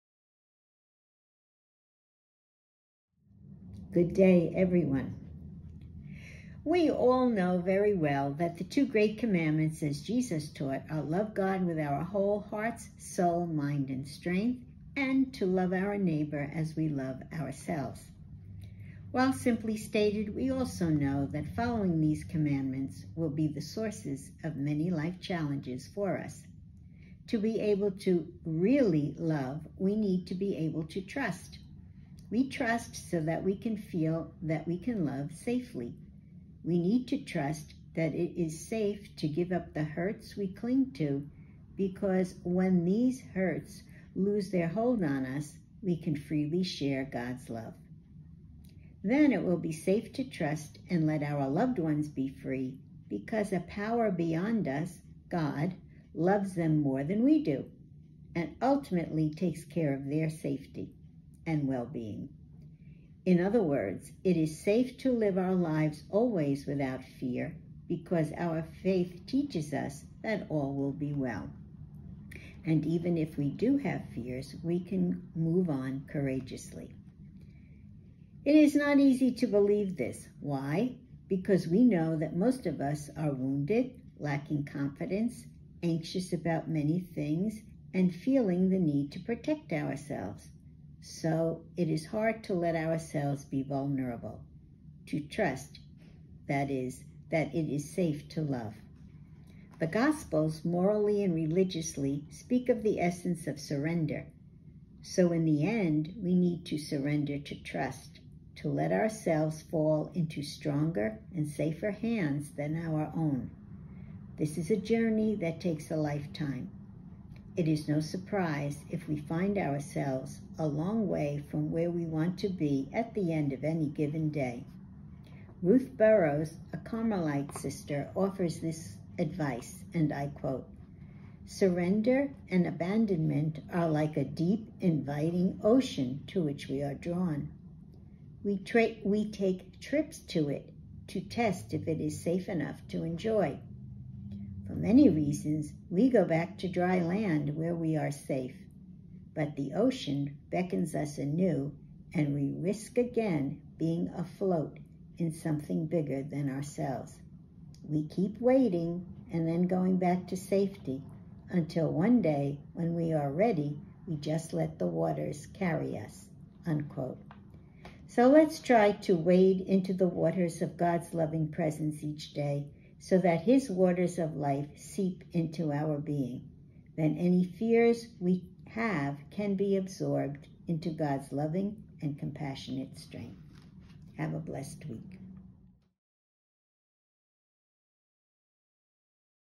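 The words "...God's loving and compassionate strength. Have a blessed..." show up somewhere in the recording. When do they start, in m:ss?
3:00.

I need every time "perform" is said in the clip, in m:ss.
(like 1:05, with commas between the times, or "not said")
not said.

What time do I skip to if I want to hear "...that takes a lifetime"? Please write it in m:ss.
1:55.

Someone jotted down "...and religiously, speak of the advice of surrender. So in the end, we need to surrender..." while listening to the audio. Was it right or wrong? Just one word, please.
wrong.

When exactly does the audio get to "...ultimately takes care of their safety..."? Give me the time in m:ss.
0:58.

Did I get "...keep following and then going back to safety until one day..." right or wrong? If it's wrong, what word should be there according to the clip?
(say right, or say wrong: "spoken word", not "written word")
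wrong: "waiting", not "following".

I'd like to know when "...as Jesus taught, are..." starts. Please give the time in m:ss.
0:09.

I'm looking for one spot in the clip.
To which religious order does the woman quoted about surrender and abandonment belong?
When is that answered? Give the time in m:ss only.
2:06.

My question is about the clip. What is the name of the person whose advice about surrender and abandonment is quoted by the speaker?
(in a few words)
Ruth Burrows.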